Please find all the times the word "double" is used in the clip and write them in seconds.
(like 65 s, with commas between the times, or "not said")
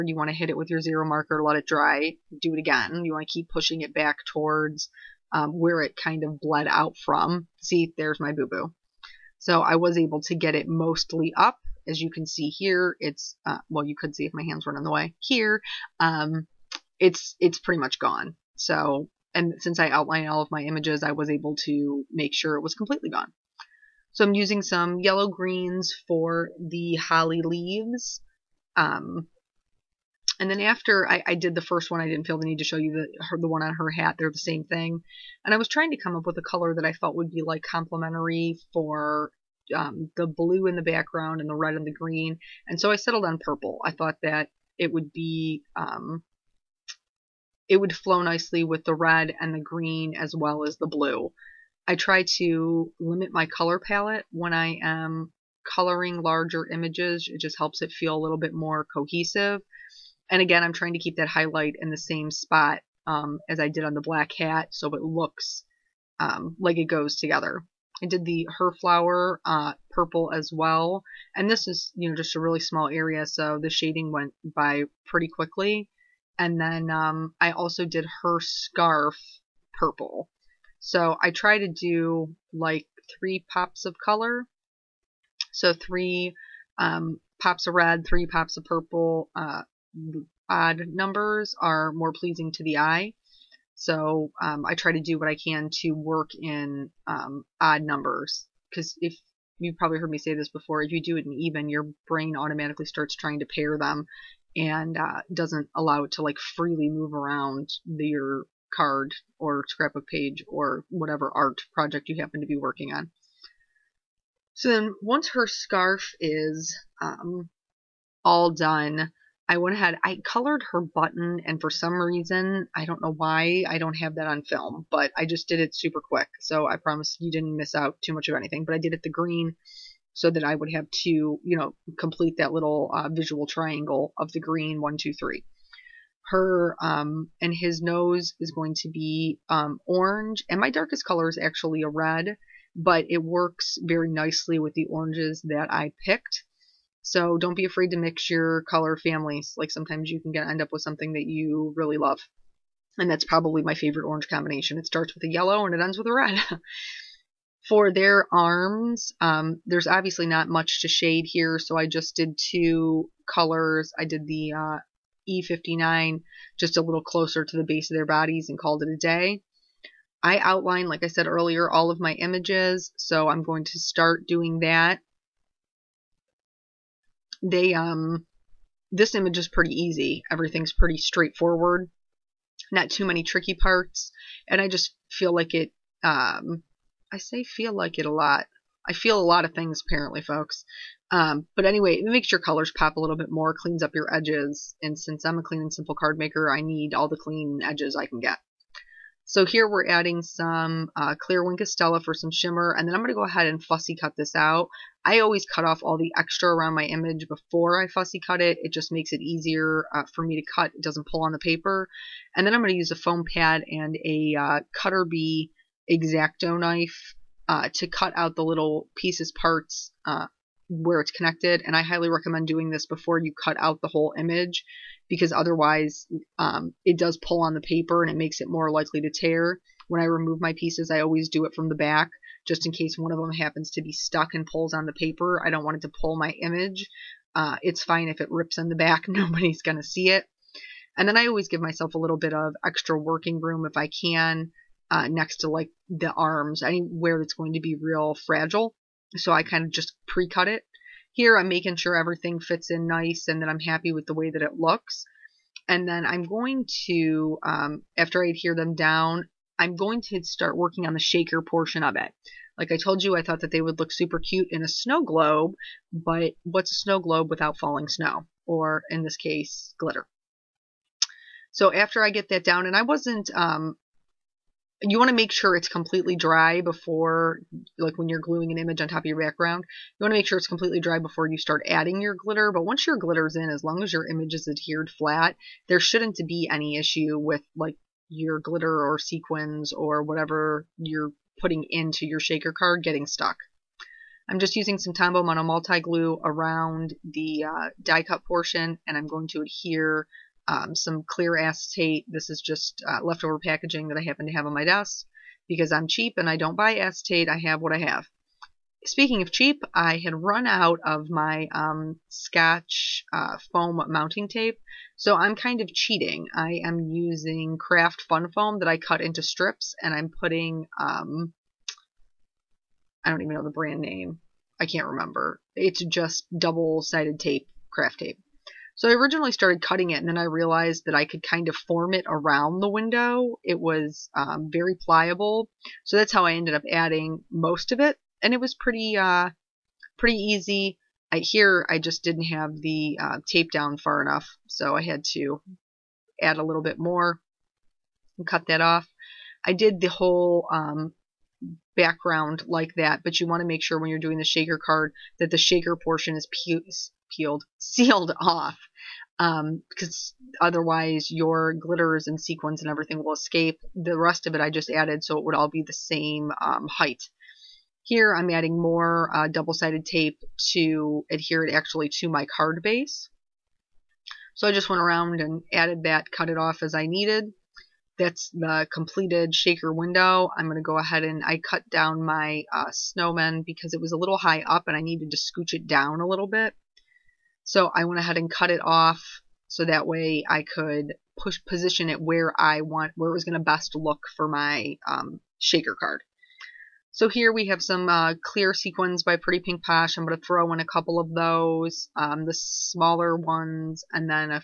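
326 s, 369 s.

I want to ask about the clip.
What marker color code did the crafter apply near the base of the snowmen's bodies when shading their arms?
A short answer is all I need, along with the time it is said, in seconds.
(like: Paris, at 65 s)
E59, at 165 s.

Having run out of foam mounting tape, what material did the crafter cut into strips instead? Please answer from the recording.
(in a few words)
Craft Fun Foam.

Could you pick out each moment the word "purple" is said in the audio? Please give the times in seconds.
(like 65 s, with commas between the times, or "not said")
43 s, 69 s, 79 s, 88 s.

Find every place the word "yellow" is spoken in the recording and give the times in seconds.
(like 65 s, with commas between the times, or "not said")
24 s, 155 s.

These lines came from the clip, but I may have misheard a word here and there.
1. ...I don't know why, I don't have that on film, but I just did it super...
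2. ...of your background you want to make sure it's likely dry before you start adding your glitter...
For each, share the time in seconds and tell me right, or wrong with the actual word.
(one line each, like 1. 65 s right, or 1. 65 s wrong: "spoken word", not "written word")
1. 122 s right
2. 278 s wrong: "completely", not "likely".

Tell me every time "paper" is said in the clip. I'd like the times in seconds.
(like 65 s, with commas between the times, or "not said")
211 s, 227 s, 234 s.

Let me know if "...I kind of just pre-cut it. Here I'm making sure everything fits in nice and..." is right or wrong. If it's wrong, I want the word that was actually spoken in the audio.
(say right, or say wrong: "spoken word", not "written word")
right.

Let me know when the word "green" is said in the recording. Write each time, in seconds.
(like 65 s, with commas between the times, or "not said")
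25 s, 41 s, 49 s, 129 s, 134 s.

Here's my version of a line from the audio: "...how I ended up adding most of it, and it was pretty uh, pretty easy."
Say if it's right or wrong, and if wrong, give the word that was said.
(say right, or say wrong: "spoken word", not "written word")
right.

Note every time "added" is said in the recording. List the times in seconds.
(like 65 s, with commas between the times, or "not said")
364 s, 375 s.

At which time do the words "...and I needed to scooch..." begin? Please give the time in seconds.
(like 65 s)
384 s.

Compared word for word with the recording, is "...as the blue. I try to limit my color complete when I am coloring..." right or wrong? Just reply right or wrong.
wrong.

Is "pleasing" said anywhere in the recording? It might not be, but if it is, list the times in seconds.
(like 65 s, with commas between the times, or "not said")
92 s.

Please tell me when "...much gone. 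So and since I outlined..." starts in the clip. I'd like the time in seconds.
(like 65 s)
17 s.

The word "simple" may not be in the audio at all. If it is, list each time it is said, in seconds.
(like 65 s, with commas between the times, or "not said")
195 s.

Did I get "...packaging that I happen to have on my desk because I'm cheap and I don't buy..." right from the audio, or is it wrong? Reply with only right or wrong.
right.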